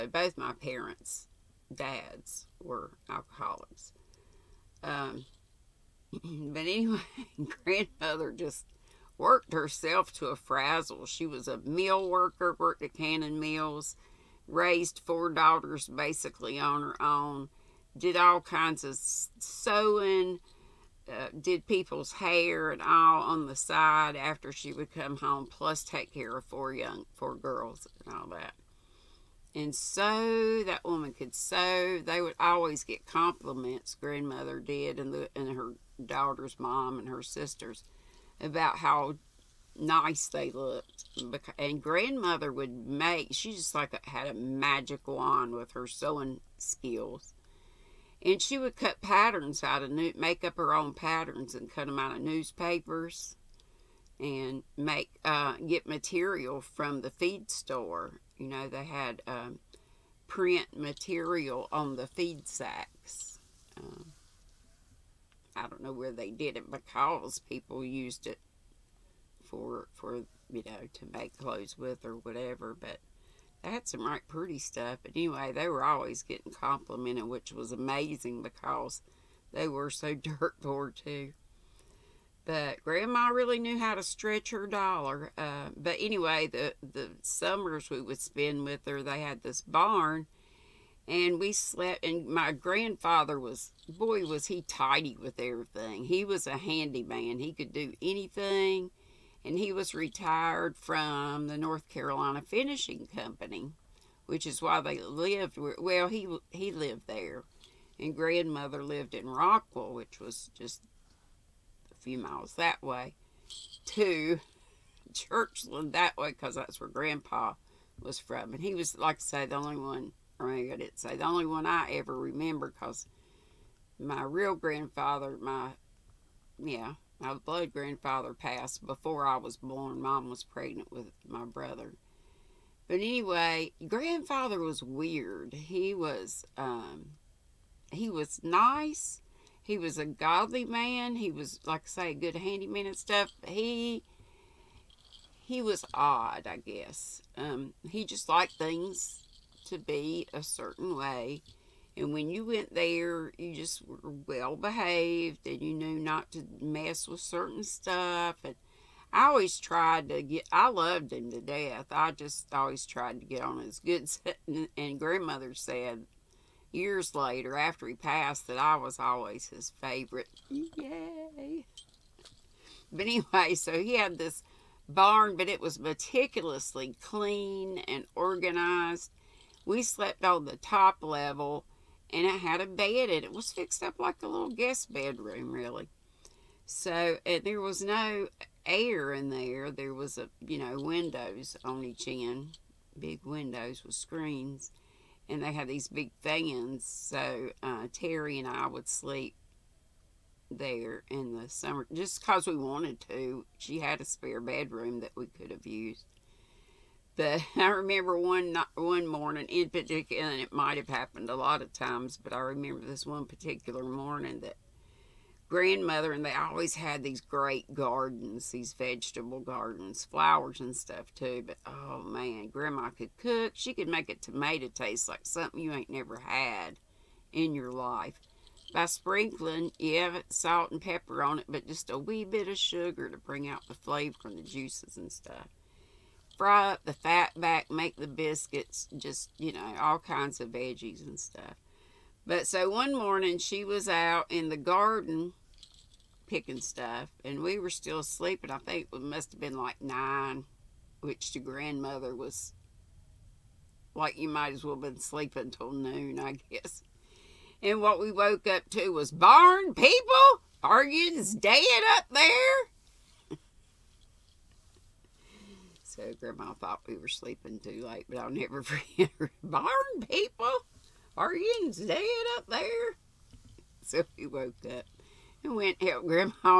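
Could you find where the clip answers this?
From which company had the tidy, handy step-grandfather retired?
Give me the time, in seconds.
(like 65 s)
101 s.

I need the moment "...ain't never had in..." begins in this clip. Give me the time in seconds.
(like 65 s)
225 s.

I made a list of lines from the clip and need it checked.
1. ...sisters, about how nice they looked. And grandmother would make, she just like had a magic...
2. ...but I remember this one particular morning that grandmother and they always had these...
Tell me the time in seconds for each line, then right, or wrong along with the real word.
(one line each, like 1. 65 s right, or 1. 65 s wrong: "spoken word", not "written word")
1. 37 s right
2. 212 s right.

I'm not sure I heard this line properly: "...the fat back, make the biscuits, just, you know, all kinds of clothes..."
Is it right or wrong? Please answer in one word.
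wrong.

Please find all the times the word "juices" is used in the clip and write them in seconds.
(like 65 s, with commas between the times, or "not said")
234 s.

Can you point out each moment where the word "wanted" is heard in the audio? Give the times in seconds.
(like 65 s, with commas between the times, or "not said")
202 s.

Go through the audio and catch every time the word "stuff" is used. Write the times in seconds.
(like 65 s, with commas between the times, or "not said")
74 s, 142 s, 157 s, 220 s, 235 s, 241 s, 246 s.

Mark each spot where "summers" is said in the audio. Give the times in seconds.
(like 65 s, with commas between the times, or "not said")
87 s, 201 s.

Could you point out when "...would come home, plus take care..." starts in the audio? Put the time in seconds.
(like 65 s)
24 s.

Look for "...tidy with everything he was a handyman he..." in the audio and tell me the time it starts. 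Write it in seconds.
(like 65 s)
94 s.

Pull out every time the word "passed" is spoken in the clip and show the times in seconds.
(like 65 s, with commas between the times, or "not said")
128 s, 167 s.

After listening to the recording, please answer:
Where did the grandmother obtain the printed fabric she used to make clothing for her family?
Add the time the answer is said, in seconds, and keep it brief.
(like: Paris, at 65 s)
the feed store, at 57 s.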